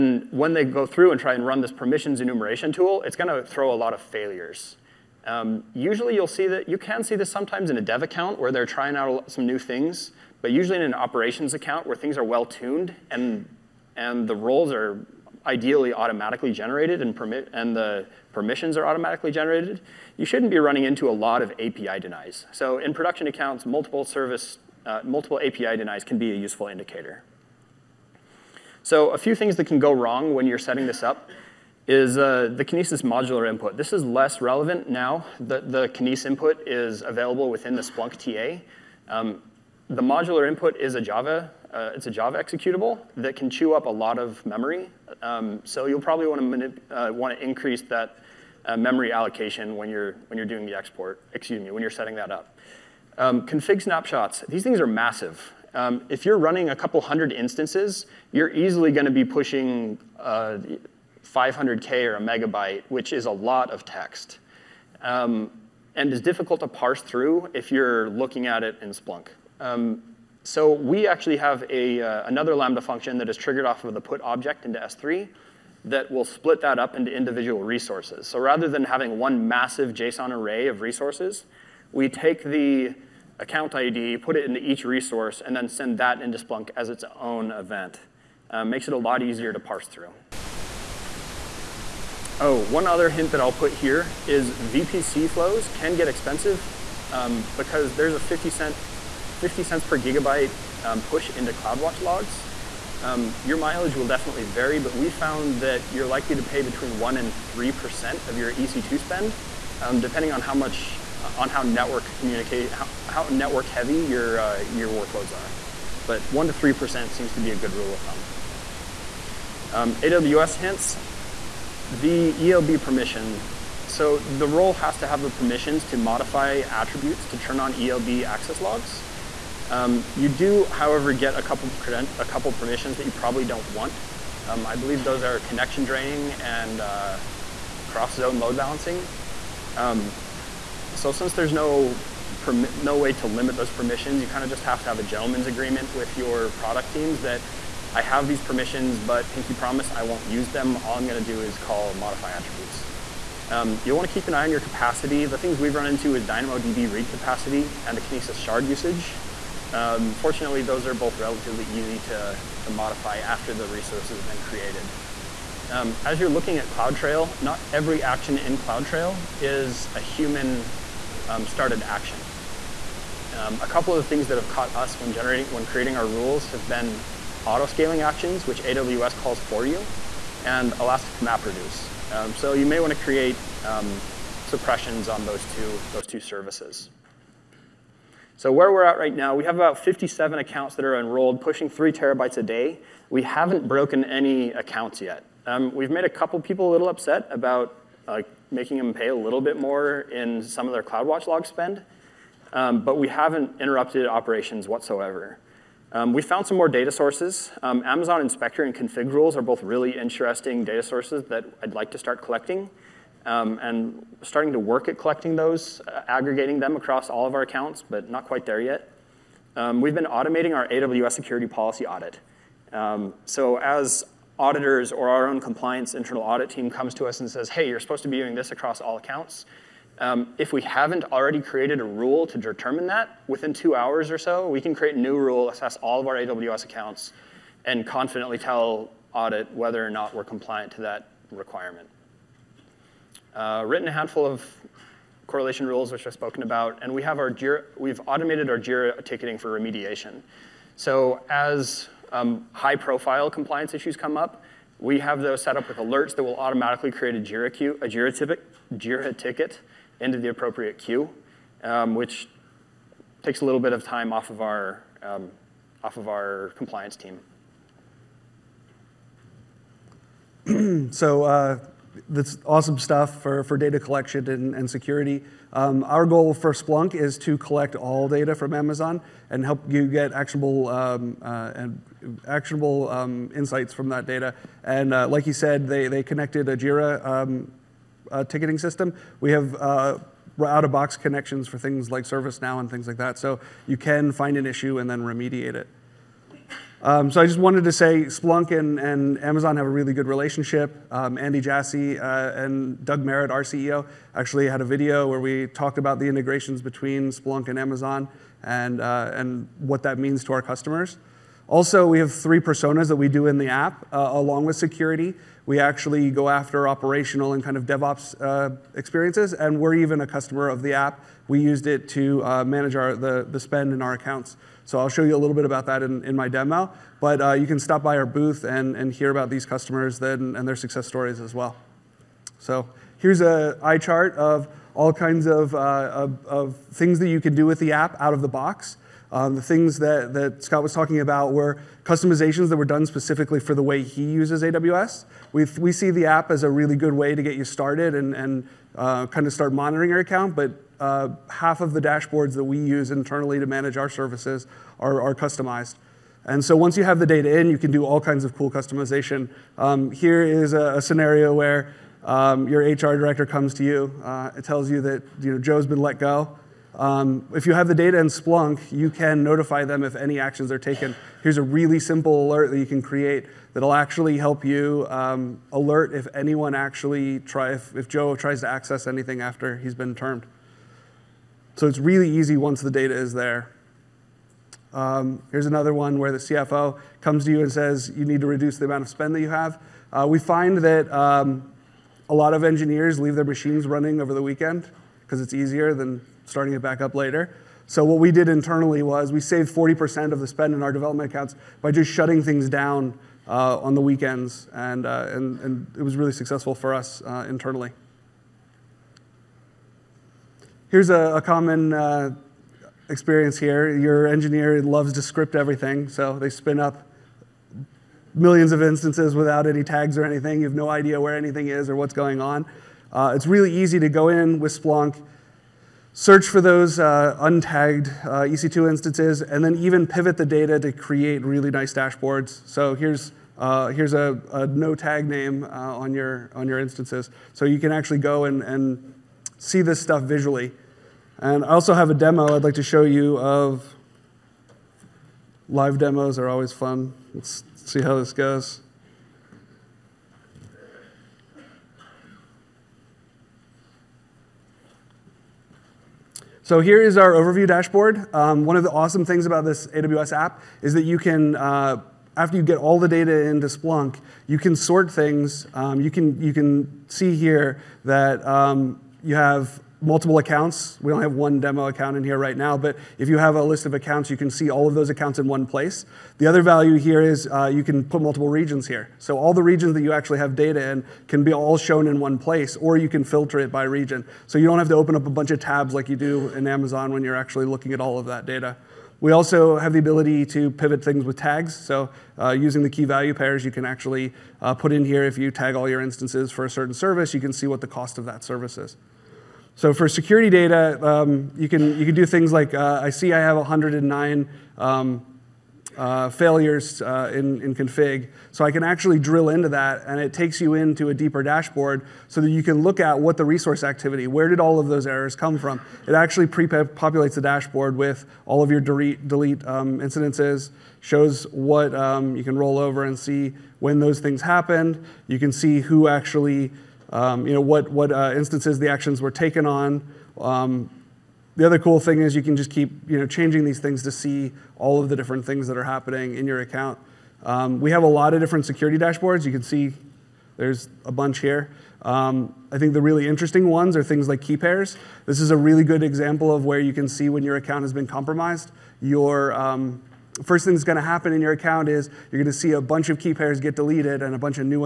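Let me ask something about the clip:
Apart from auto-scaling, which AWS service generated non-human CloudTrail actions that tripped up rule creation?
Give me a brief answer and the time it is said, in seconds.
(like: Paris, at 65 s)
Elastic MapReduce, at 180 s.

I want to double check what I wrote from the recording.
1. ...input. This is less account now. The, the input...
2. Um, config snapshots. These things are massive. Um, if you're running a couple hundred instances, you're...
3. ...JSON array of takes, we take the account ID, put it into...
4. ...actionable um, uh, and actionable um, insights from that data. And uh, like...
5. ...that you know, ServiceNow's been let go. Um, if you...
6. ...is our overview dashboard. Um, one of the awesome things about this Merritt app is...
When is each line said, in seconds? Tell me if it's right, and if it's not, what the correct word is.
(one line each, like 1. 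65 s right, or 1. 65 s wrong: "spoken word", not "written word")
1. 33 s wrong: "relevant", not "account"
2. 53 s right
3. 79 s wrong: "resources", not "takes"
4. 280 s right
5. 364 s wrong: "Joe", not "ServiceNow"
6. 456 s wrong: "AWS", not "Merritt".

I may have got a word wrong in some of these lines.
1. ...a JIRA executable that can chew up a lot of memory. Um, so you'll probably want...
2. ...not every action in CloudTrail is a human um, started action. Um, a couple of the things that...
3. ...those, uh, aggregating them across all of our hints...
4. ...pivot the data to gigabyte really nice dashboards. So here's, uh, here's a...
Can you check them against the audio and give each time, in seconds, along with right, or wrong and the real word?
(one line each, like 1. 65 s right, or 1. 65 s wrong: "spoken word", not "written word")
1. 42 s wrong: "Java", not "JIRA"
2. 167 s right
3. 215 s wrong: "accounts", not "hints"
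4. 429 s wrong: "create", not "gigabyte".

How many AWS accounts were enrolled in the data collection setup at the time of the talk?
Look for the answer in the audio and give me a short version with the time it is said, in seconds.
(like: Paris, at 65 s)
57, at 189 s.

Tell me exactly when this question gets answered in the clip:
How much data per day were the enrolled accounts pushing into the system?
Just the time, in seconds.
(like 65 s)
191 s.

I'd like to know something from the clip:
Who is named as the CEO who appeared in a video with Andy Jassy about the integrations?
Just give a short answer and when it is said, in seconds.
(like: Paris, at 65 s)
Doug Merritt, at 302 s.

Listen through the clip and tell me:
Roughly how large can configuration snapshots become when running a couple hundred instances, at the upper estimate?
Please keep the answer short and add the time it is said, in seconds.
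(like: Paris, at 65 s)
a megabyte, at 62 s.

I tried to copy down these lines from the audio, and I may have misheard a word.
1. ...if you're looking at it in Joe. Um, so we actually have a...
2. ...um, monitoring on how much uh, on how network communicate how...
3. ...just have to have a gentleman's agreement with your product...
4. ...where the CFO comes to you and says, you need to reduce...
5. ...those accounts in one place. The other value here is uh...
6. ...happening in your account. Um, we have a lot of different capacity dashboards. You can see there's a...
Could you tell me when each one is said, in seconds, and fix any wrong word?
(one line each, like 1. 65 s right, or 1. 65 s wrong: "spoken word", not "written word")
1. 67 s wrong: "Splunk", not "Joe"
2. 109 s wrong: "depending", not "monitoring"
3. 144 s right
4. 385 s right
5. 474 s right
6. 535 s wrong: "security", not "capacity".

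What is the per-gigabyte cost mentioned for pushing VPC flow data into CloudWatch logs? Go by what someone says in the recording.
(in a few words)
50 cents.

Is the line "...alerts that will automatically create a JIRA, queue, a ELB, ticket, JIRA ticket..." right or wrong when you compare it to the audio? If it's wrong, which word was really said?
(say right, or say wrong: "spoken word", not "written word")
wrong: "JIRA", not "ELB".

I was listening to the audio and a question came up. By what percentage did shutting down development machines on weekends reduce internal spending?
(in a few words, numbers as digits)
40%.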